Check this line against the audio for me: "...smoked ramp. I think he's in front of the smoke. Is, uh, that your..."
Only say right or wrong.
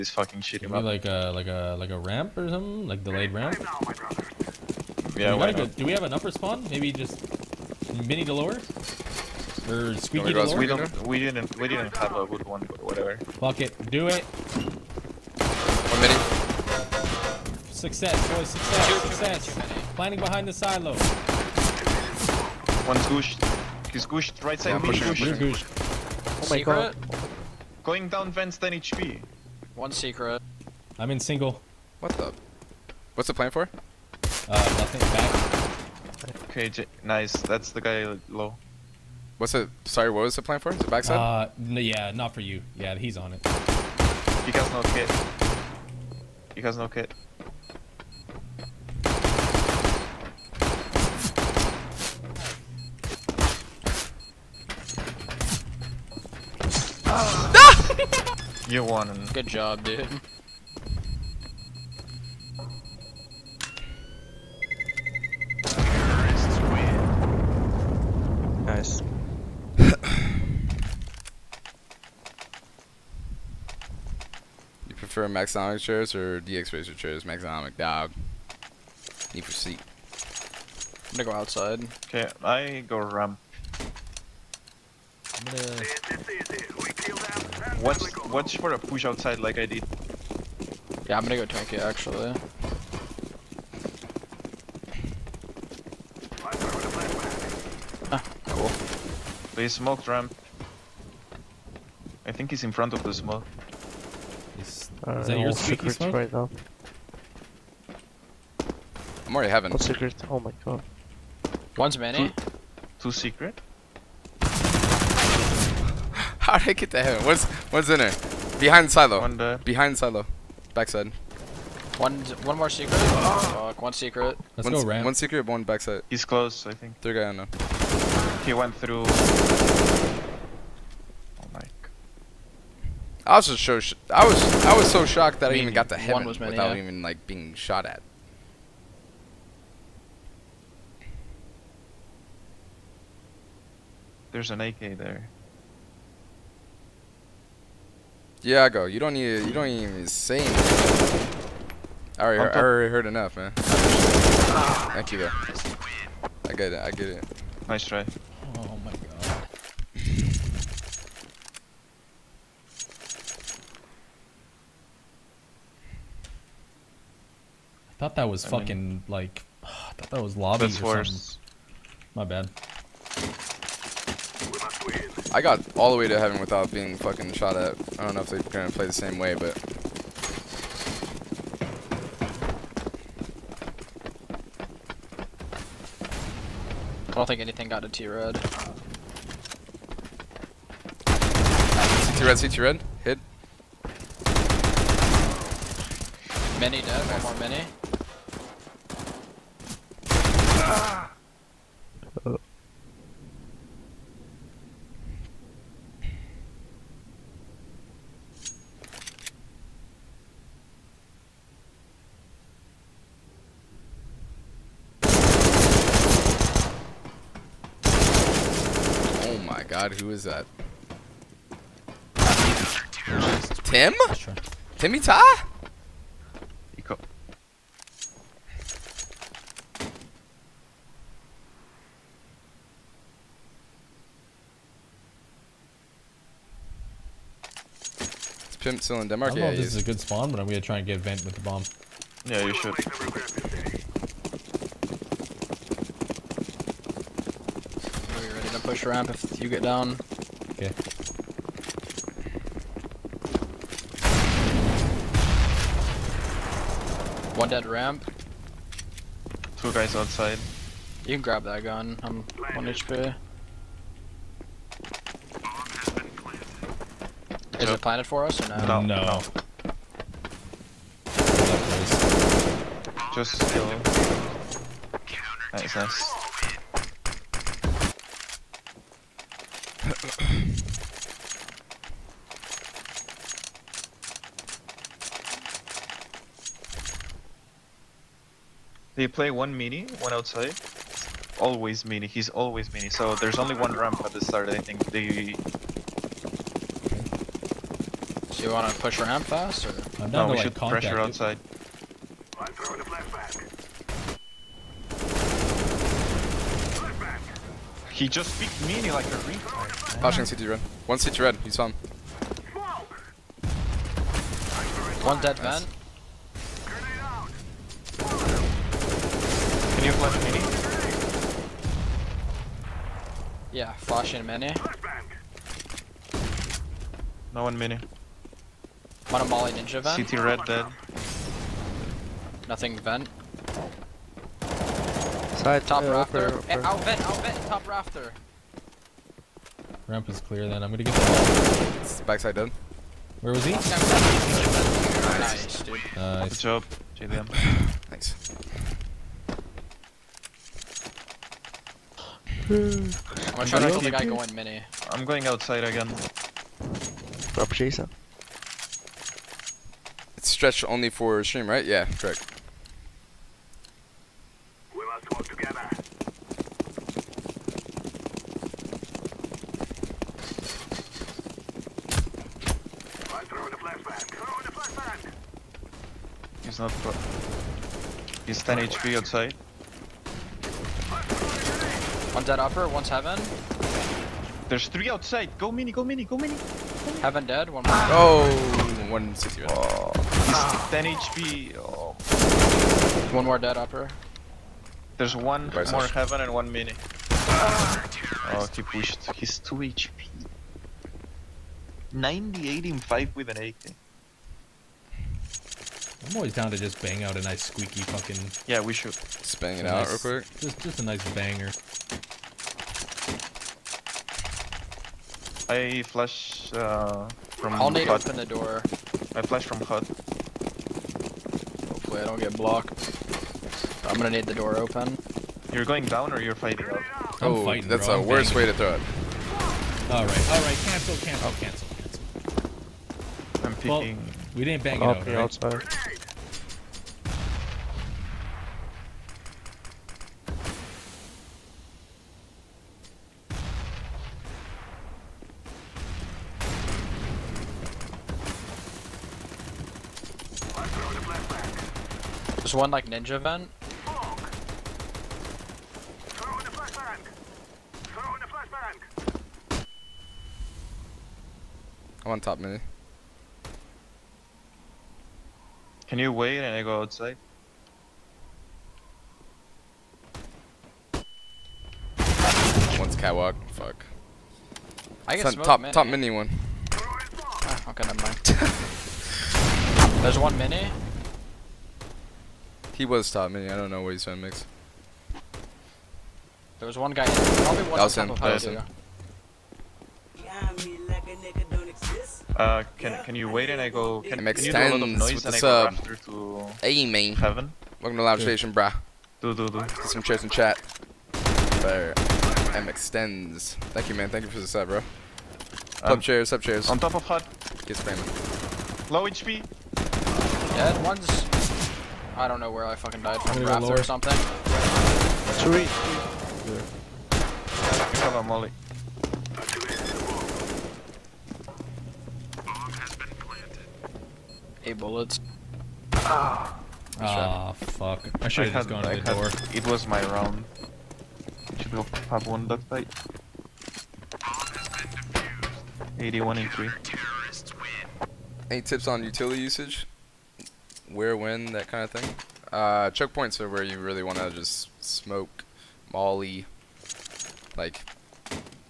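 right.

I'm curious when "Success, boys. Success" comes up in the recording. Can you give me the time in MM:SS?
00:17.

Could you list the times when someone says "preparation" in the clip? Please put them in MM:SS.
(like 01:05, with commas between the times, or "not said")
not said.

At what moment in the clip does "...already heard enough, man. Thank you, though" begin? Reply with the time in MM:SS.
02:32.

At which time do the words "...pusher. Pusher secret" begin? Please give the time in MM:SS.
00:25.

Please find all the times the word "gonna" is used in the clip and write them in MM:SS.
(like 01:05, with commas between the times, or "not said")
01:21, 01:25, 01:31, 02:58, 04:00, 05:40, 05:53, 07:03.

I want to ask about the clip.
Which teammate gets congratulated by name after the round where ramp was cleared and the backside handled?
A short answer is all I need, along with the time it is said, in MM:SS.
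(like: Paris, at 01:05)
JDM, at 05:46.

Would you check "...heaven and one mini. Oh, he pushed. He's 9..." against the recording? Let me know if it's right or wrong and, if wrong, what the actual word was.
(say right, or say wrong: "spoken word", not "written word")
wrong: "2", not "9".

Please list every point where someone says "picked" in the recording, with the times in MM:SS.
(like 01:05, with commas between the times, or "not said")
05:08.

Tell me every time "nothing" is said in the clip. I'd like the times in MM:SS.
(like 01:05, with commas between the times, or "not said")
00:34, 05:32.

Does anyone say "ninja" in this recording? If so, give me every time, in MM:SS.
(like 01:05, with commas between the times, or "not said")
05:29, 07:32.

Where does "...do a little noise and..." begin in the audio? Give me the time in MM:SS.
08:14.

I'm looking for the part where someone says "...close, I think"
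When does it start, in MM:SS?
02:06.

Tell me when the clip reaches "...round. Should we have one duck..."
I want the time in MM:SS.
08:50.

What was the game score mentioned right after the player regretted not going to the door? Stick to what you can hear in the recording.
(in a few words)
8-3.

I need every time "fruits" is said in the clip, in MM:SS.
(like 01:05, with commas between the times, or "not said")
not said.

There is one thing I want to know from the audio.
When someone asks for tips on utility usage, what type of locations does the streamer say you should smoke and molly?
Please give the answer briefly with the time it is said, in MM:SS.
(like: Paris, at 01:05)
choke points, at 09:02.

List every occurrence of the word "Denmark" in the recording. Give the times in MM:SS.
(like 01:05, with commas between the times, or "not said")
03:59.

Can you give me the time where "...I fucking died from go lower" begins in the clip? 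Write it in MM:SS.
08:32.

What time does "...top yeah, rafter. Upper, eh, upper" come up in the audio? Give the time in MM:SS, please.
05:35.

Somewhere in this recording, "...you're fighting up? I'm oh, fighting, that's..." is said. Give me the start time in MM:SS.
07:06.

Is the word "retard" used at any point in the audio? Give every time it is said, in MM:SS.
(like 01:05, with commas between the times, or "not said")
05:09.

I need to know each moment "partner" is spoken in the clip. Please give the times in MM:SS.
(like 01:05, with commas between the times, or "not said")
not said.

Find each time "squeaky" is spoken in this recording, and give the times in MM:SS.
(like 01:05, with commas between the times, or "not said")
00:10, 06:47.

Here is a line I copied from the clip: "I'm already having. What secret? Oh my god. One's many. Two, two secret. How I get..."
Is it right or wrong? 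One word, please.
right.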